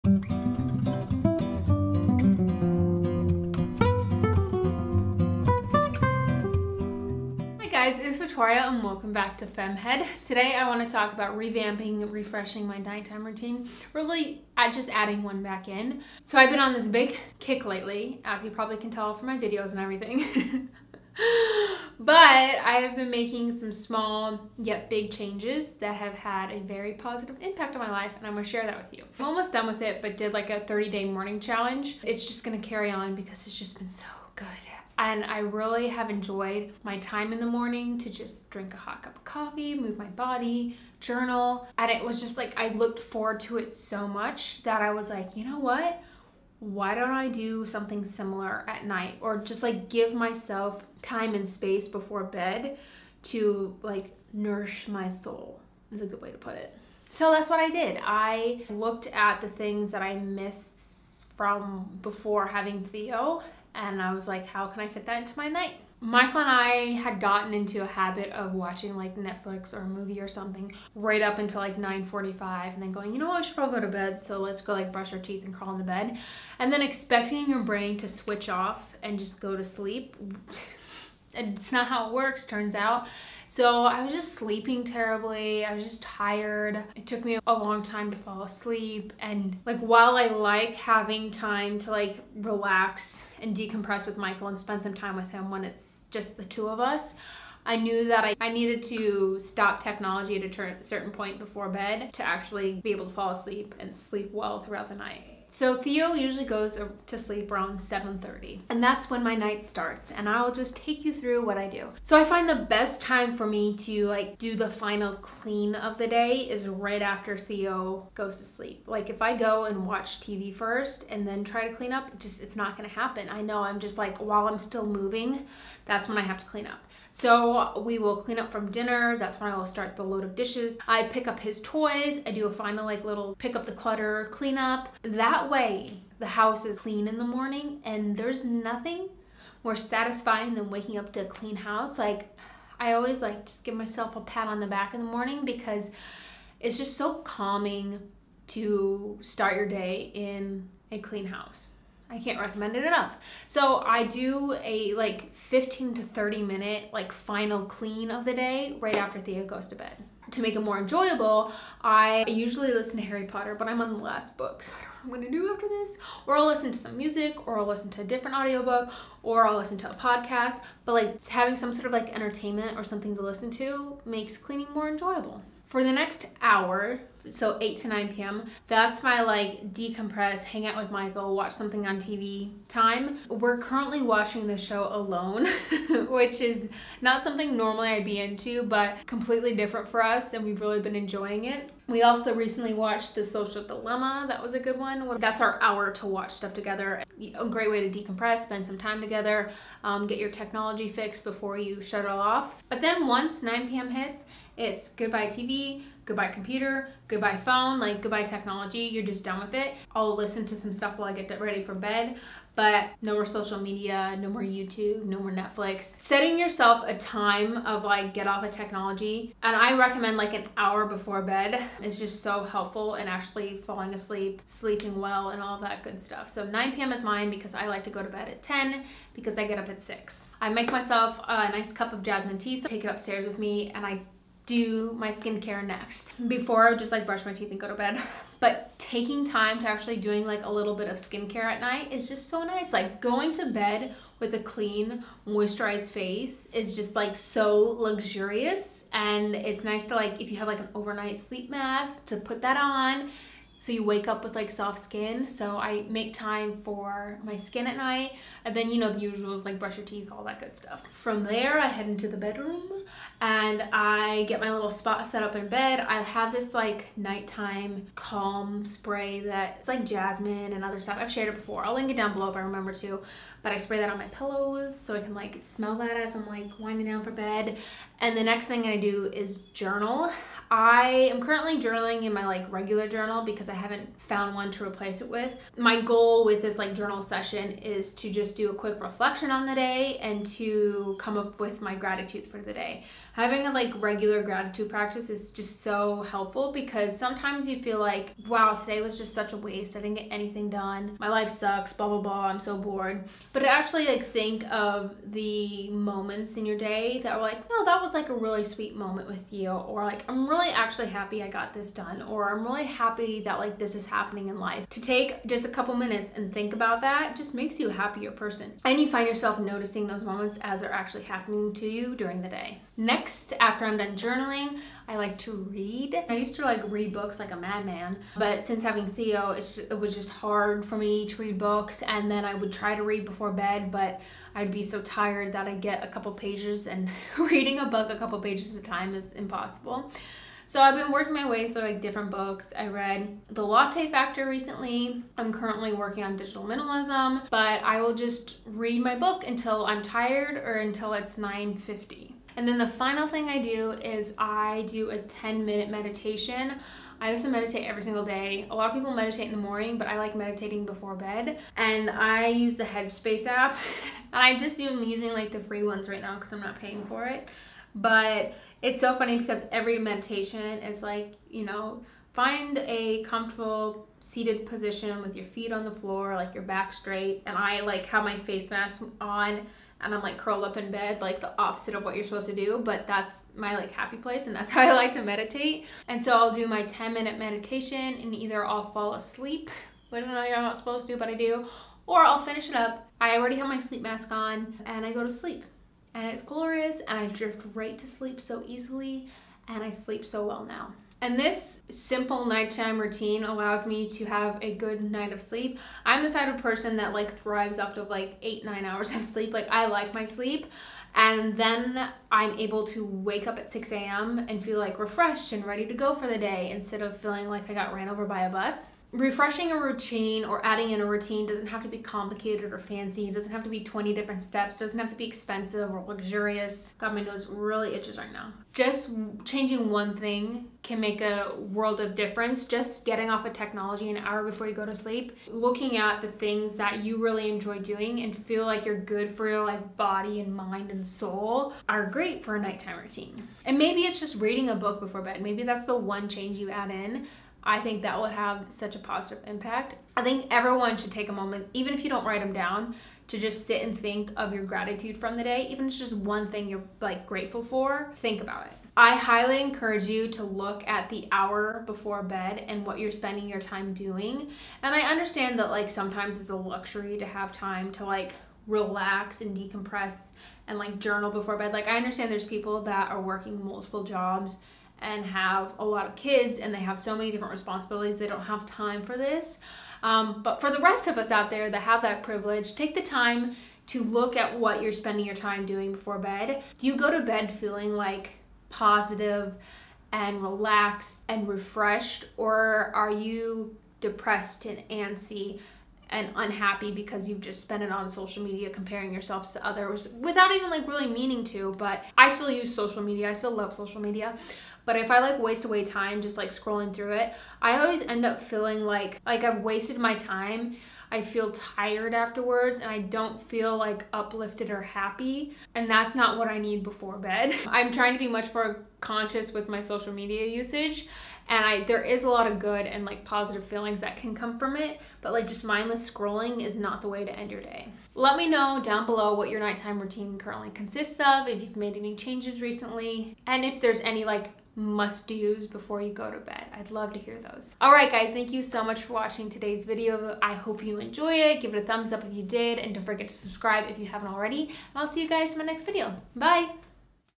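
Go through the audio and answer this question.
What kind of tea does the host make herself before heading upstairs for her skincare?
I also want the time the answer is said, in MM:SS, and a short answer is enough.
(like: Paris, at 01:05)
jasmine tea, at 03:52.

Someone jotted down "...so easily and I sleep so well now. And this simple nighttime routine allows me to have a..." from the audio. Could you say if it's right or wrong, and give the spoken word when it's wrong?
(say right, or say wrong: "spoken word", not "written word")
right.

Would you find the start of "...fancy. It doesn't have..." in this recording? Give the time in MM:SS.
07:02.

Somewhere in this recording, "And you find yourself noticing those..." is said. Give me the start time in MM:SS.
05:18.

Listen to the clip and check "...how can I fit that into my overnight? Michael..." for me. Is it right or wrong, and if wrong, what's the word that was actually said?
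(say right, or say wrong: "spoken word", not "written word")
wrong: "night", not "overnight".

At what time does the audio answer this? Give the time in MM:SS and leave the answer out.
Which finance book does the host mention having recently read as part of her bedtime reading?
05:43.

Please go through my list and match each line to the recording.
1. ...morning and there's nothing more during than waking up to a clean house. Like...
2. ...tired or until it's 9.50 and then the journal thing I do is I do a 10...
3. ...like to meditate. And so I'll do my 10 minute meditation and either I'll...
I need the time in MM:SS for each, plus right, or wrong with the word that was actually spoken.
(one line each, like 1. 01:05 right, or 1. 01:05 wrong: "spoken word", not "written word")
1. 02:17 wrong: "satisfying", not "during"
2. 05:49 wrong: "final", not "journal"
3. 06:24 right.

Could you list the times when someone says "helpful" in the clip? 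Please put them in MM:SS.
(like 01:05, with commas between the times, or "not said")
03:42, 04:56.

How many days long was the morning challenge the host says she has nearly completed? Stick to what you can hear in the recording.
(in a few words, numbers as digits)
30.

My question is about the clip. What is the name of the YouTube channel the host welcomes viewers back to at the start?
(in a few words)
FemmeHead.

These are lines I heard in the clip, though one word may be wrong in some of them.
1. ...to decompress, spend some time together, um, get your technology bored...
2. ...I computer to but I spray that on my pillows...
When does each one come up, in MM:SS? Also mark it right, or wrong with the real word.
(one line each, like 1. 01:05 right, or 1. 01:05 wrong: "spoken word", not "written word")
1. 03:17 wrong: "fixed", not "bored"
2. 04:32 wrong: "remember", not "computer".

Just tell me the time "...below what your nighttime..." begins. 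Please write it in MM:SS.
08:48.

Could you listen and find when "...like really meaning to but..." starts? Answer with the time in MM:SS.
08:20.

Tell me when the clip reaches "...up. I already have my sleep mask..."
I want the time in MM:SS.
06:32.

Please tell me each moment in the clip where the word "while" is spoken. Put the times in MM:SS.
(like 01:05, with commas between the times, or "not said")
01:29, 02:04, 03:30.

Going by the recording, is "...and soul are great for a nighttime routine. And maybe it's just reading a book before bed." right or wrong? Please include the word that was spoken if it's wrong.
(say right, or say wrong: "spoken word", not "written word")
right.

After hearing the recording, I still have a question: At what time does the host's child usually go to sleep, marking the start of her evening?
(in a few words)
7:30.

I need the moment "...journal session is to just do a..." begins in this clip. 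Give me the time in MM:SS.
04:46.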